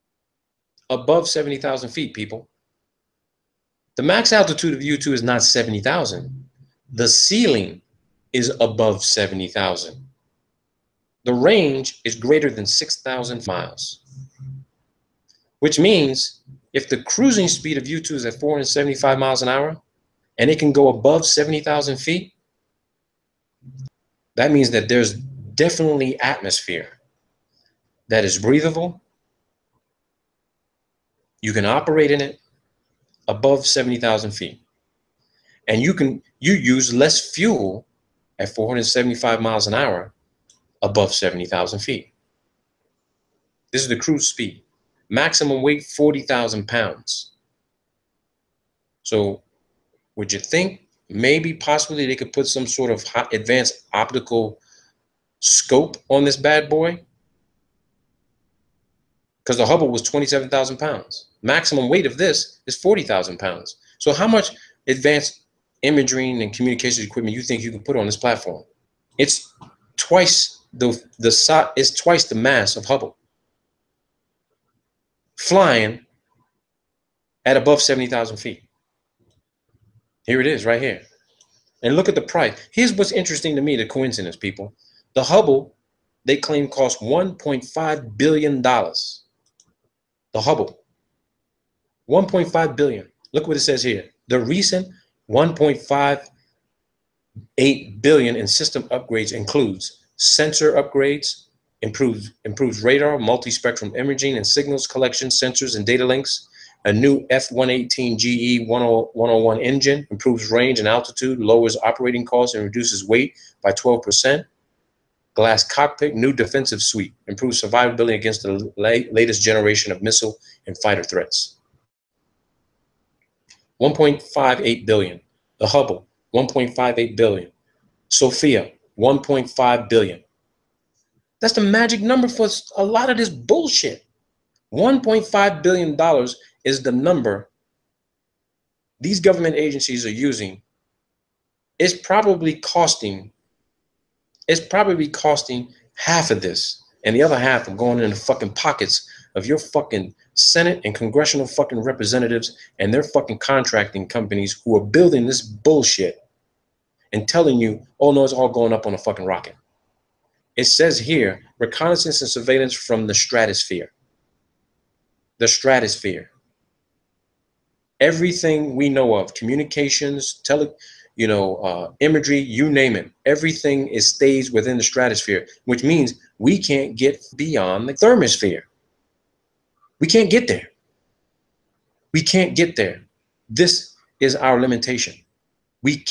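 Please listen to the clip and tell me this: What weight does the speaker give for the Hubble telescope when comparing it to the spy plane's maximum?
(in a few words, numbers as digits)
27,000 pounds.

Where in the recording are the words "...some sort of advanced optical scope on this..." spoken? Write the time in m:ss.
0:52.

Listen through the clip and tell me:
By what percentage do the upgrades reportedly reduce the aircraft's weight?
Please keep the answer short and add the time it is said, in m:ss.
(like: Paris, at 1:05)
12%, at 1:53.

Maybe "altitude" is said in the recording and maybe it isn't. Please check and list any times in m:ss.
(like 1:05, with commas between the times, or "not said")
0:04, 1:50.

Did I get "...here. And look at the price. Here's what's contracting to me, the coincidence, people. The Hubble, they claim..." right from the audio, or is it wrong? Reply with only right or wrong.
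wrong.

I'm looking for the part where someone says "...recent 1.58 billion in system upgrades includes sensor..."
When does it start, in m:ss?
1:34.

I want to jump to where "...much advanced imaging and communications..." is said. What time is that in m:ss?
1:04.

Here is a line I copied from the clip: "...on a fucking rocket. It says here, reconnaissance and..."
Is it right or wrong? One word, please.
right.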